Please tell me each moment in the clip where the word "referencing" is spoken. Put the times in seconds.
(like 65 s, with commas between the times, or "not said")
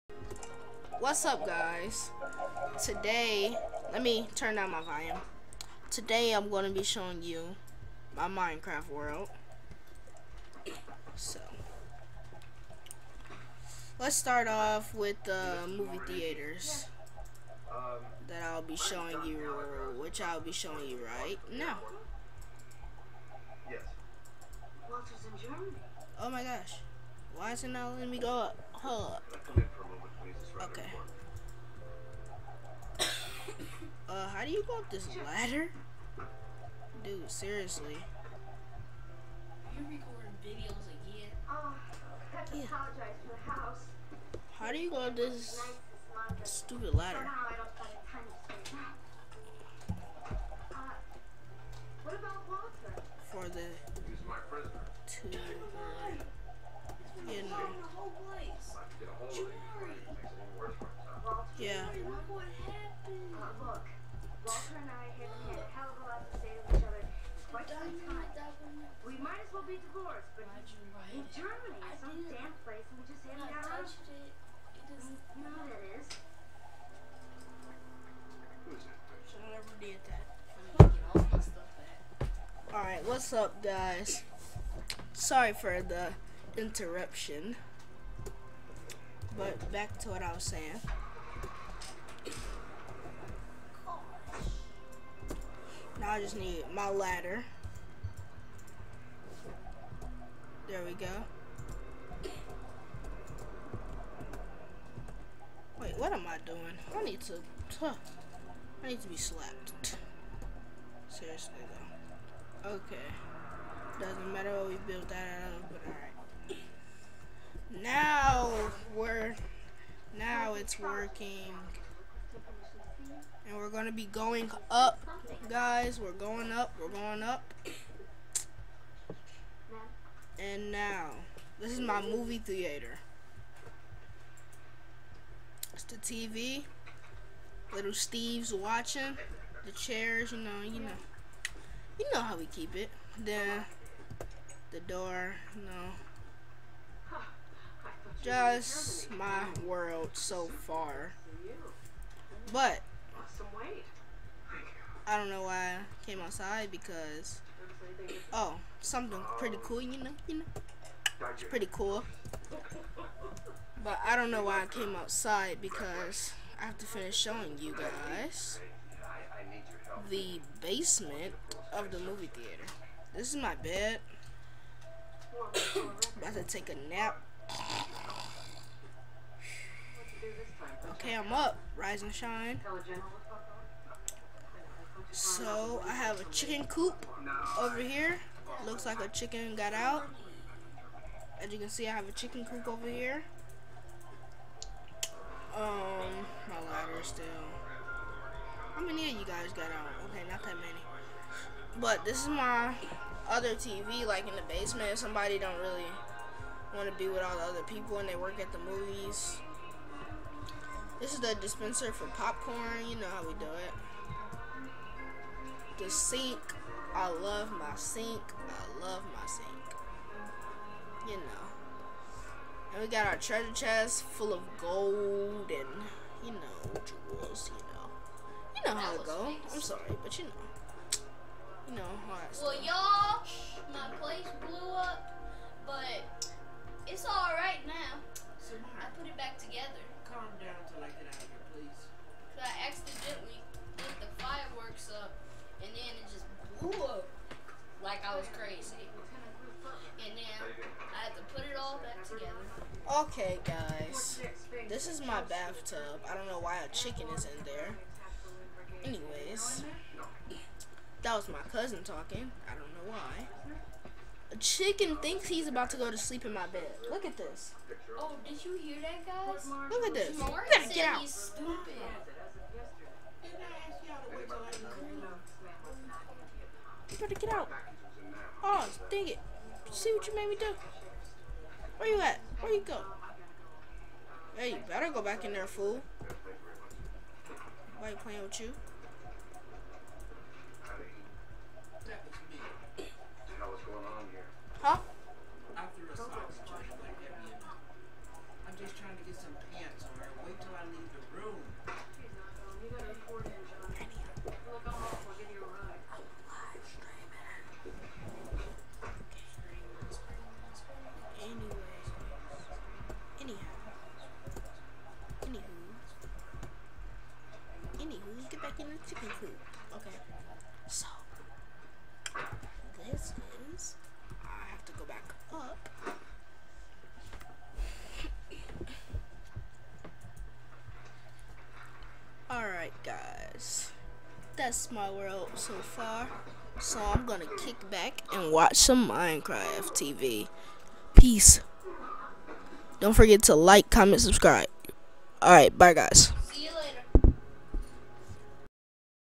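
not said.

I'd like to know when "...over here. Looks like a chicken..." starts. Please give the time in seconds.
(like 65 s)
187 s.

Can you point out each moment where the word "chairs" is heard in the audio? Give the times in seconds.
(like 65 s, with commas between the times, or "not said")
139 s.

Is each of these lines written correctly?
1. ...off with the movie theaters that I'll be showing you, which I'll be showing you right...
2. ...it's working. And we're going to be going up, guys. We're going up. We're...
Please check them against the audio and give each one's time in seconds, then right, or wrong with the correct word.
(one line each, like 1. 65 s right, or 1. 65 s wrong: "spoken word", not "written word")
1. 14 s right
2. 120 s right.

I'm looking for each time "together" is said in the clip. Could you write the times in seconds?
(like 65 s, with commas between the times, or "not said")
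239 s, 252 s.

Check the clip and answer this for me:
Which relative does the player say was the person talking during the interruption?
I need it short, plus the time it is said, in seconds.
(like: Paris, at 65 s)
cousin, at 261 s.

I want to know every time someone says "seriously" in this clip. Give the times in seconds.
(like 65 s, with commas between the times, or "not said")
37 s, 111 s.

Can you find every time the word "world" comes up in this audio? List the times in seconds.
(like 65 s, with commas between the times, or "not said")
8 s, 149 s, 334 s.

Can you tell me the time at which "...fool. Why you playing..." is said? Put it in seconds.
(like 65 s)
285 s.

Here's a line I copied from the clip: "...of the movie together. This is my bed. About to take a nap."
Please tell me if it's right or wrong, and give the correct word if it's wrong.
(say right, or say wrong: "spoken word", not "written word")
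wrong: "theater", not "together".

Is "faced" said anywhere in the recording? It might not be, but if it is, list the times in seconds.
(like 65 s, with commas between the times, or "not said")
not said.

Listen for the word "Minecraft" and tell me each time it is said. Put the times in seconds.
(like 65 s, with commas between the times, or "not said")
8 s, 338 s.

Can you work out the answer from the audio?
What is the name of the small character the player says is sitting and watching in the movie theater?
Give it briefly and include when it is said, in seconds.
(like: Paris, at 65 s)
Little Steve, at 137 s.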